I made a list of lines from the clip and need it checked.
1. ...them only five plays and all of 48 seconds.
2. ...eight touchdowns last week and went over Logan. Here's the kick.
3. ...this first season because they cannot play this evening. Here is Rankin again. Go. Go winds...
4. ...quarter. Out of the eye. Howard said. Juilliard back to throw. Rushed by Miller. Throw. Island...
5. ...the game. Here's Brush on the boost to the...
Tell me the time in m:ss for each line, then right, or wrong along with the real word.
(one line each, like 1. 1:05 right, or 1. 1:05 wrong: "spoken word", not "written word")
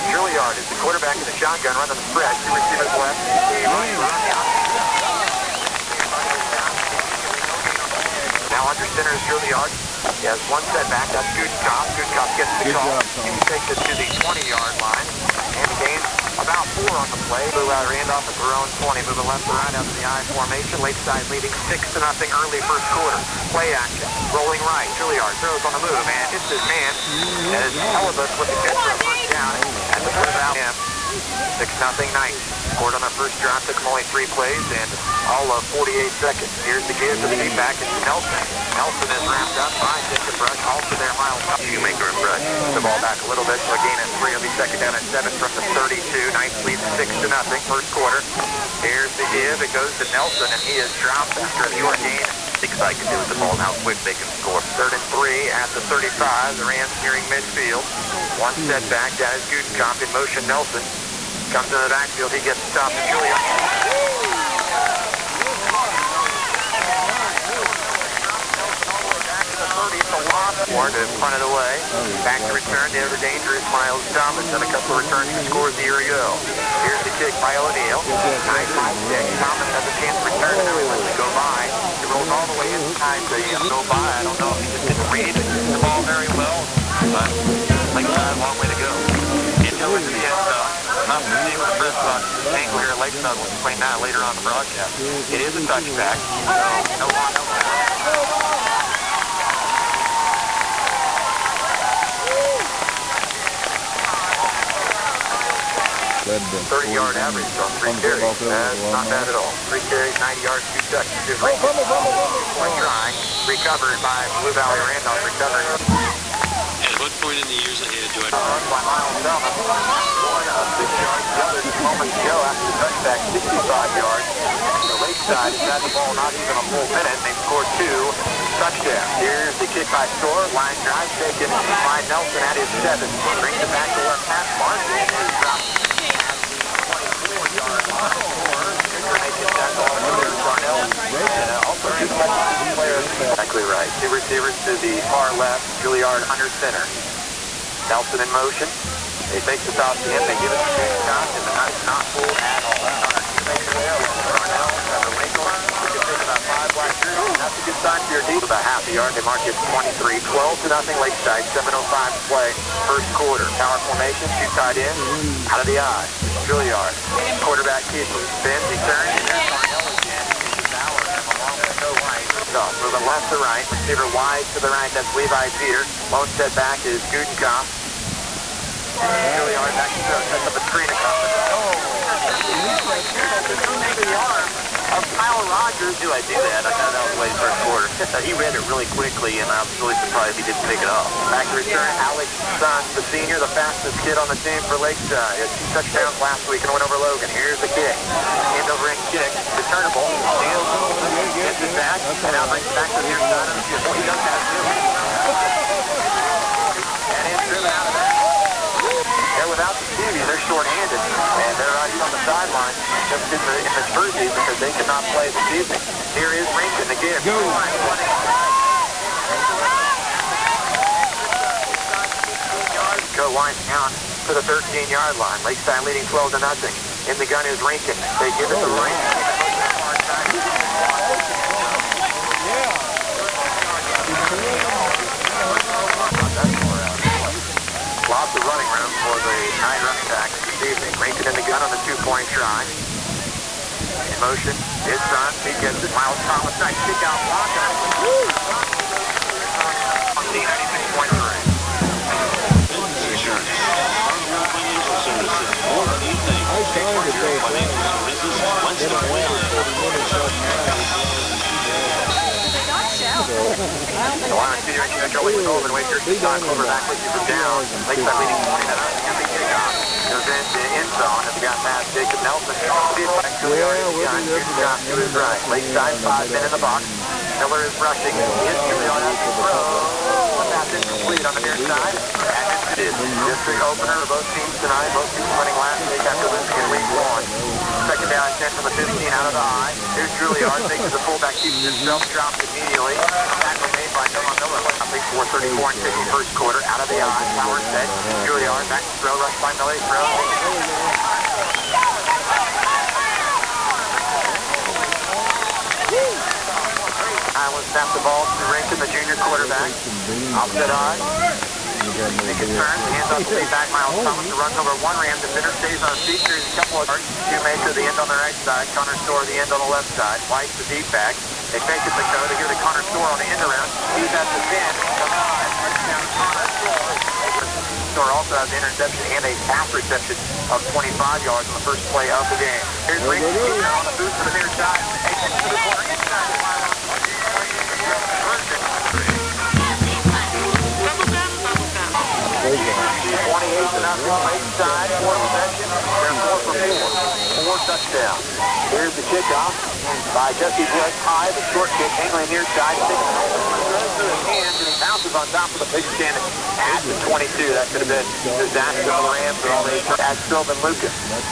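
1. 0:33 wrong: "three", not "five"
2. 3:15 wrong: "two", not "eight"
3. 3:33 right
4. 4:56 right
5. 5:32 wrong: "Ray", not "Brush".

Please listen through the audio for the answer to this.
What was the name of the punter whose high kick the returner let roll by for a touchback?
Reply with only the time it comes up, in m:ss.
1:17.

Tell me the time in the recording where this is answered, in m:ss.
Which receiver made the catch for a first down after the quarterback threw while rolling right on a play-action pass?
0:27.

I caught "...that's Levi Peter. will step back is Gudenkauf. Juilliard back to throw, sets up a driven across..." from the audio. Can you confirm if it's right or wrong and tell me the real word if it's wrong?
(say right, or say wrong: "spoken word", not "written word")
wrong: "screen", not "driven".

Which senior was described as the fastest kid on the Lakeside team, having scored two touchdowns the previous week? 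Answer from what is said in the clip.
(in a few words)
Alex Sun.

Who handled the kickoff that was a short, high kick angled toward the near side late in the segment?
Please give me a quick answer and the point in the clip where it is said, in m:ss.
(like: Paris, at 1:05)
Jesse Wood, at 5:50.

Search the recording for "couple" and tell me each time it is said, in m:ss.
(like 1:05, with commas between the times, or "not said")
1:14, 5:16.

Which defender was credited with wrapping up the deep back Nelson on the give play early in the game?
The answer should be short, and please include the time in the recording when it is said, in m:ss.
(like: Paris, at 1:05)
Jacob Brush, at 0:40.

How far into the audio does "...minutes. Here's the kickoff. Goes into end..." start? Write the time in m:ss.
4:28.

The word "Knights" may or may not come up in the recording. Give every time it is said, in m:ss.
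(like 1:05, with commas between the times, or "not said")
0:32, 0:46.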